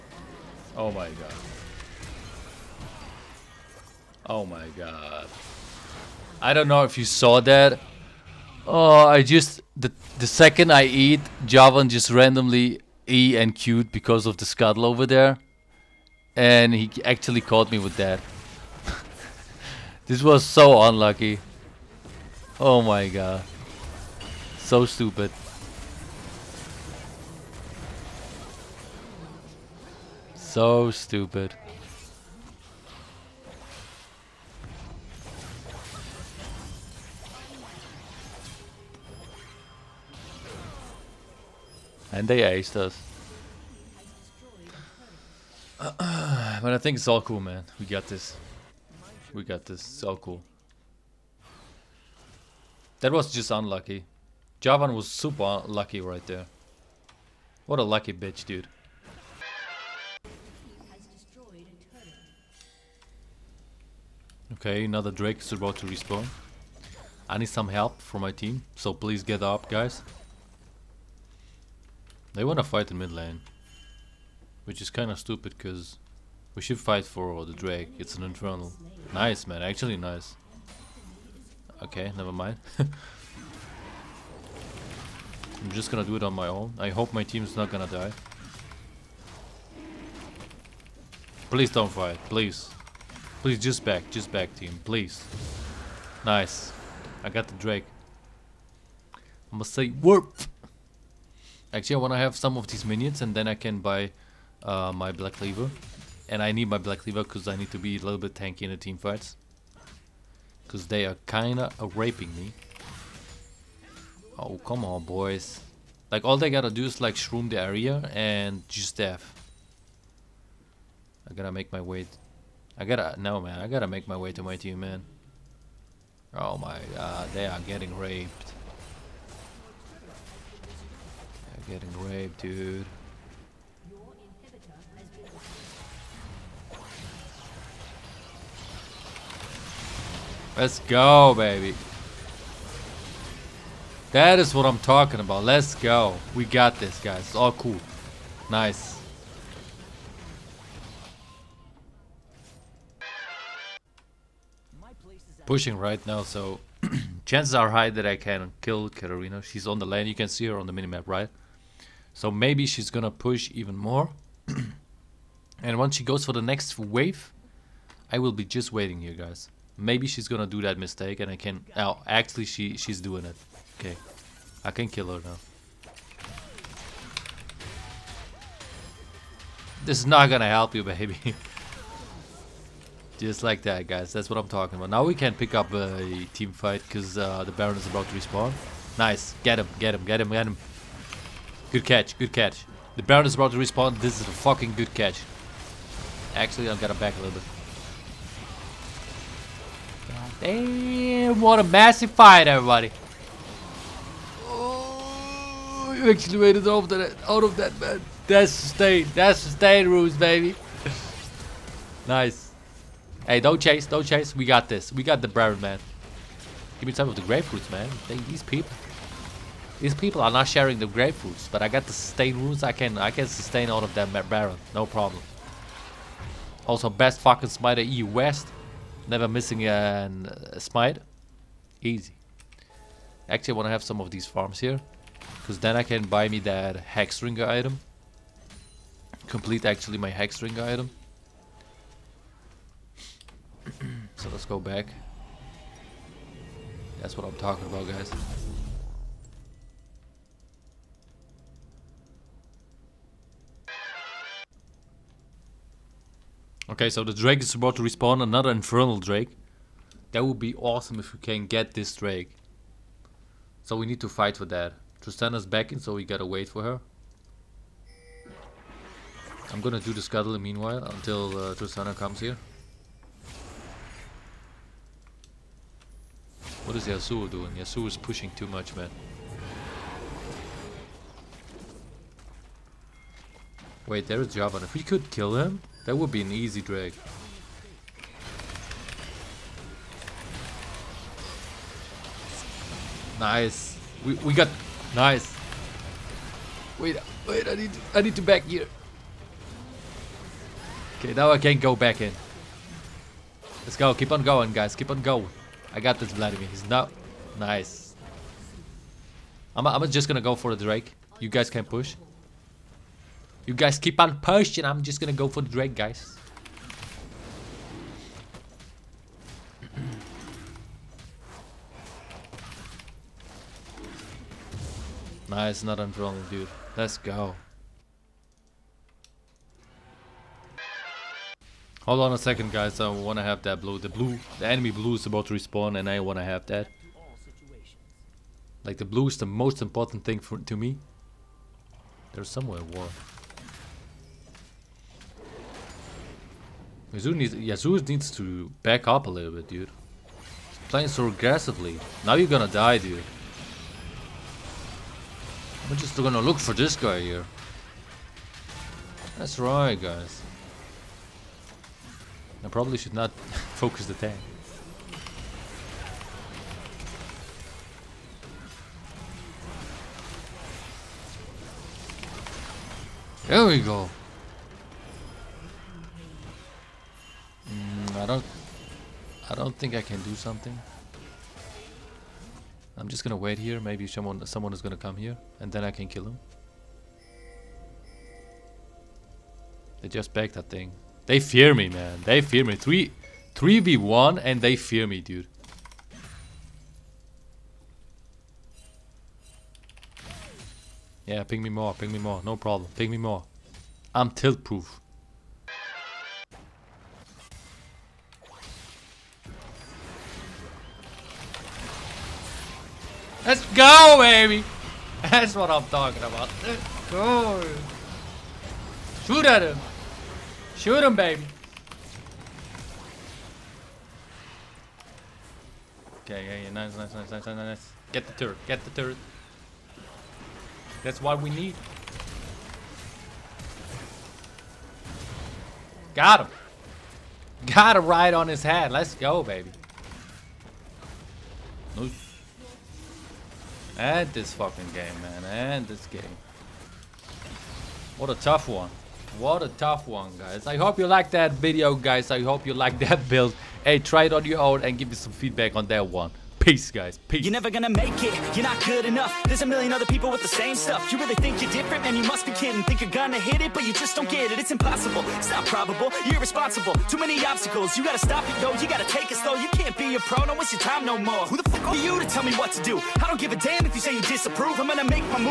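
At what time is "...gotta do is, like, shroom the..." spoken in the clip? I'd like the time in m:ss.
1:56.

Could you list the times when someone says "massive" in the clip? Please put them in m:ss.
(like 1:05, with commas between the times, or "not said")
3:21.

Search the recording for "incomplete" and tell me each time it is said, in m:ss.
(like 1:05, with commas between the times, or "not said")
not said.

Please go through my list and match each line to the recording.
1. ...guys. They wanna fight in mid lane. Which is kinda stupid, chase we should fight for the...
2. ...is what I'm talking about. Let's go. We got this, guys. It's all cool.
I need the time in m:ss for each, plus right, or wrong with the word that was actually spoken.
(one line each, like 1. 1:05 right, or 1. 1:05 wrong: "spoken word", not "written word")
1. 1:09 wrong: "cause", not "chase"
2. 2:24 right.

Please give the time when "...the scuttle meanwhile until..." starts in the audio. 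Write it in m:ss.
4:29.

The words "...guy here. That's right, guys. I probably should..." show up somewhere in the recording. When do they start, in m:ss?
5:56.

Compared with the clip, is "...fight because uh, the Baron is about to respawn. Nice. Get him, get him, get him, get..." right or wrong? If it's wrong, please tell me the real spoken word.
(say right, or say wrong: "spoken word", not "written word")
right.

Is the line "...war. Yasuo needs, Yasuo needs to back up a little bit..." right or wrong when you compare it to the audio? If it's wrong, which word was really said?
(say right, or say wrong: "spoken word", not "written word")
right.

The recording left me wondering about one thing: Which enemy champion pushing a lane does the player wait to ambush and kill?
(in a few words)
Katarina.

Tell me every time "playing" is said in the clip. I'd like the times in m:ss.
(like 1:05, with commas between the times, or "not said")
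5:50.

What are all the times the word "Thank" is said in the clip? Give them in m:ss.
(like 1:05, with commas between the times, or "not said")
3:38.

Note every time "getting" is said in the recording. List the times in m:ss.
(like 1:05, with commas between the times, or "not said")
2:07, 2:11.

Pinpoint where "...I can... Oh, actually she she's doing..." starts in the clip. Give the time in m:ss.
2:51.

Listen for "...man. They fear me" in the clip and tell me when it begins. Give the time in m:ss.
6:31.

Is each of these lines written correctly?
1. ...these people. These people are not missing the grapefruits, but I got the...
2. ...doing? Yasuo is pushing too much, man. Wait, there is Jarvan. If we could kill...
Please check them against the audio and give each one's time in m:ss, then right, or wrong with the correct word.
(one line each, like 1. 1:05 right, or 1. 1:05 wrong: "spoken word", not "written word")
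1. 3:38 wrong: "sharing", not "missing"
2. 4:37 right.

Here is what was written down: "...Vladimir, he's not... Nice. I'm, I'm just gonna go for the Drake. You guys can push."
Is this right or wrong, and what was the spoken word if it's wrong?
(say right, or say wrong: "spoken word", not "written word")
right.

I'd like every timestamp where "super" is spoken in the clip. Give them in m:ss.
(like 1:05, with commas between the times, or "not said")
0:55.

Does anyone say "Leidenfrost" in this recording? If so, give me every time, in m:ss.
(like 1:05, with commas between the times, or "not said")
not said.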